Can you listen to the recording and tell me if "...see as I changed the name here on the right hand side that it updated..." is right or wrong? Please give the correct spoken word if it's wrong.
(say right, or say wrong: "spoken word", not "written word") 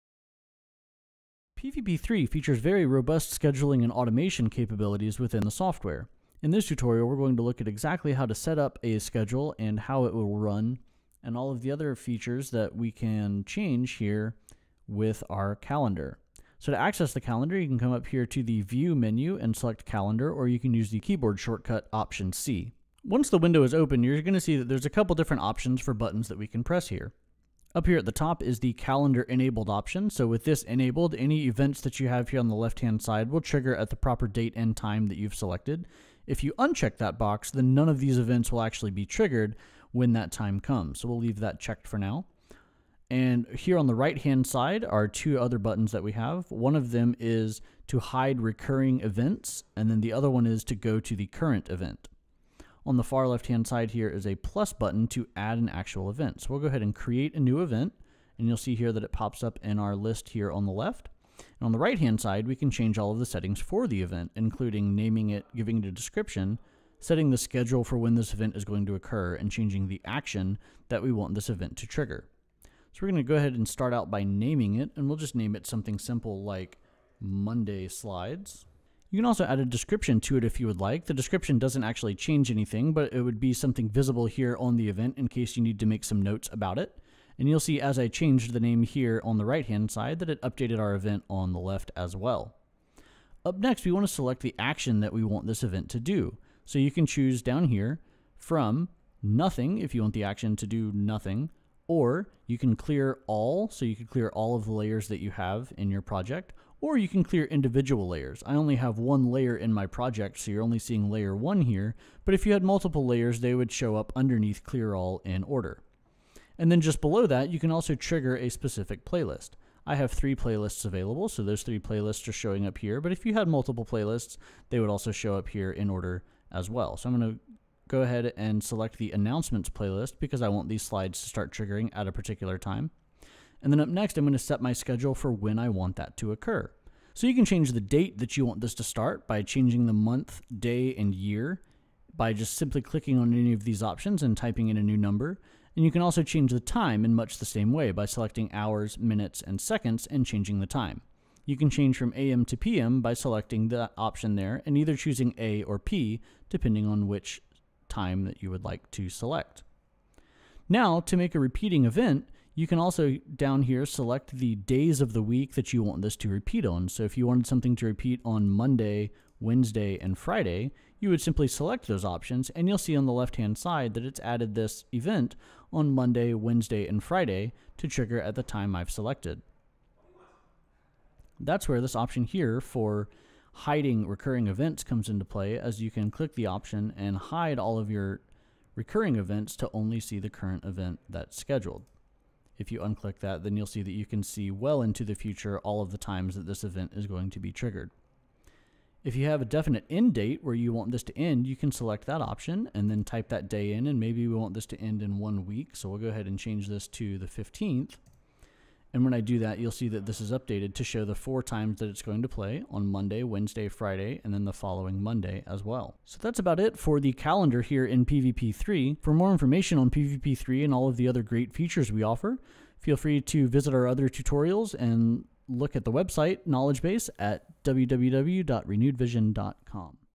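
right.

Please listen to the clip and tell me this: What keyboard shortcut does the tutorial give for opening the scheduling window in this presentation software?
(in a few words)
Option C.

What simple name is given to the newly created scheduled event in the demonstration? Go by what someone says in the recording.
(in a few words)
Monday Slides.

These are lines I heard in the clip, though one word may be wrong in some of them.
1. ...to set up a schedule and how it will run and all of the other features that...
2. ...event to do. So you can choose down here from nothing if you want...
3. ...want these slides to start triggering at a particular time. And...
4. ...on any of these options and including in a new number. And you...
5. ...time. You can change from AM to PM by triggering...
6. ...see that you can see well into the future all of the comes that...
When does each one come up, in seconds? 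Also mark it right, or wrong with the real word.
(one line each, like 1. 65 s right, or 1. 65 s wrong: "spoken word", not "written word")
1. 8 s right
2. 95 s right
3. 130 s right
4. 143 s wrong: "typing", not "including"
5. 150 s wrong: "selecting", not "triggering"
6. 193 s wrong: "times", not "comes".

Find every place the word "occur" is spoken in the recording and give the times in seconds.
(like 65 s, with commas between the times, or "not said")
68 s, 136 s.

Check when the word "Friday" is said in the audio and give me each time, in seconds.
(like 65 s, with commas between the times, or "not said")
170 s, 177 s, 213 s.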